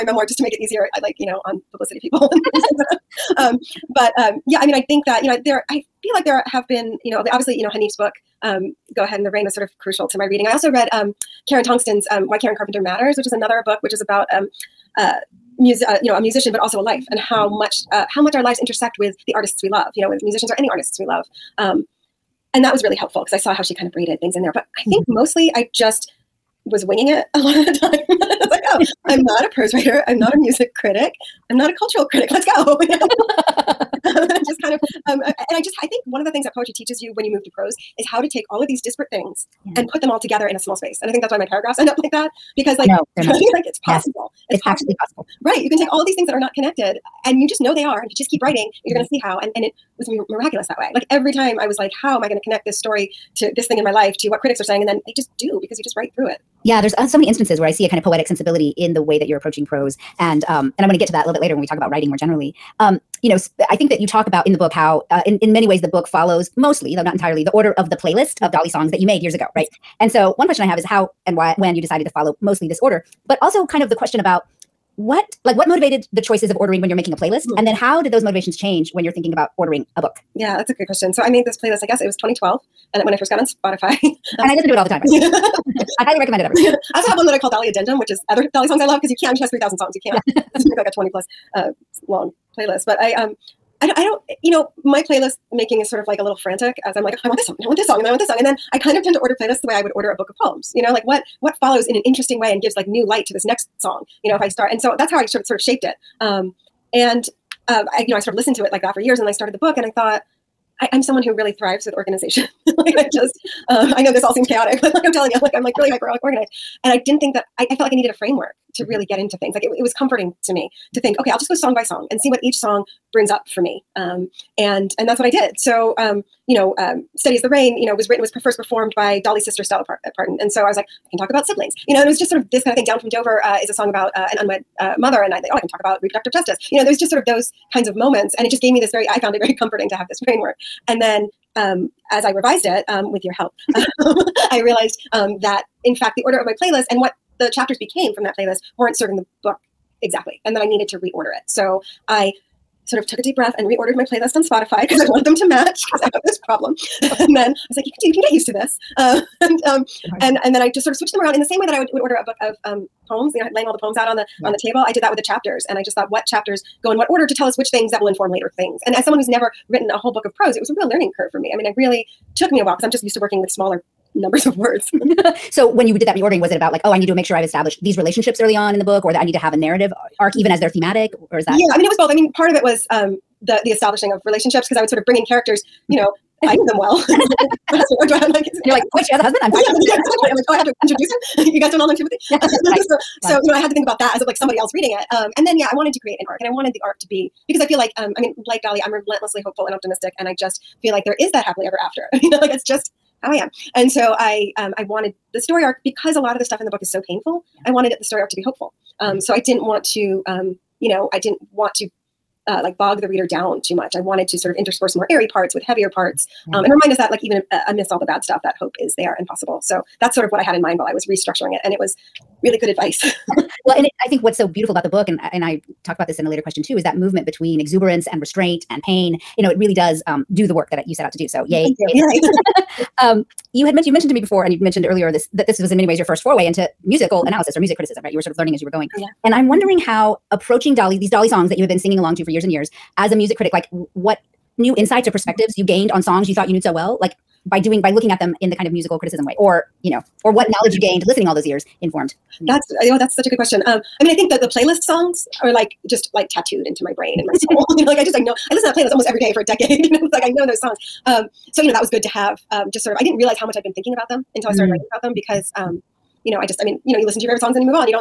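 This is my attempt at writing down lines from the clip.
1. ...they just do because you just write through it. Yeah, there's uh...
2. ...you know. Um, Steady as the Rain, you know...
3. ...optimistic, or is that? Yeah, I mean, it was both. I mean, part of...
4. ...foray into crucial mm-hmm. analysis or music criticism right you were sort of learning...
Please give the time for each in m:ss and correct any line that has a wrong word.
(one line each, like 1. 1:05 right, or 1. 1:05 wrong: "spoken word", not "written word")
1. 0:55 right
2. 2:06 right
3. 3:00 wrong: "thematic", not "optimistic"
4. 3:56 wrong: "musical", not "crucial".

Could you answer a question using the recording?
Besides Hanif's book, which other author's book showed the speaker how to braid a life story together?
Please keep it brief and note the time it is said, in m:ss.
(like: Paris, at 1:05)
Karen Tongson, at 0:11.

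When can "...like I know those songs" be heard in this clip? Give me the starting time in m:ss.
4:20.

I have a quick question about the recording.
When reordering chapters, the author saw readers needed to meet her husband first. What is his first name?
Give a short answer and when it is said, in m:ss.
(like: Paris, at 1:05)
Timothy, at 3:11.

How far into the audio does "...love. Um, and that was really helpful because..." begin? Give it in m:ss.
0:21.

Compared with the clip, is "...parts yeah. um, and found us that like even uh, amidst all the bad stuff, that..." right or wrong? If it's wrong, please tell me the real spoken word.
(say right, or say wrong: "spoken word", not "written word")
wrong: "remind", not "found".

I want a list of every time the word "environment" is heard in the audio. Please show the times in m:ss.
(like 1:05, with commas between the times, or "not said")
not said.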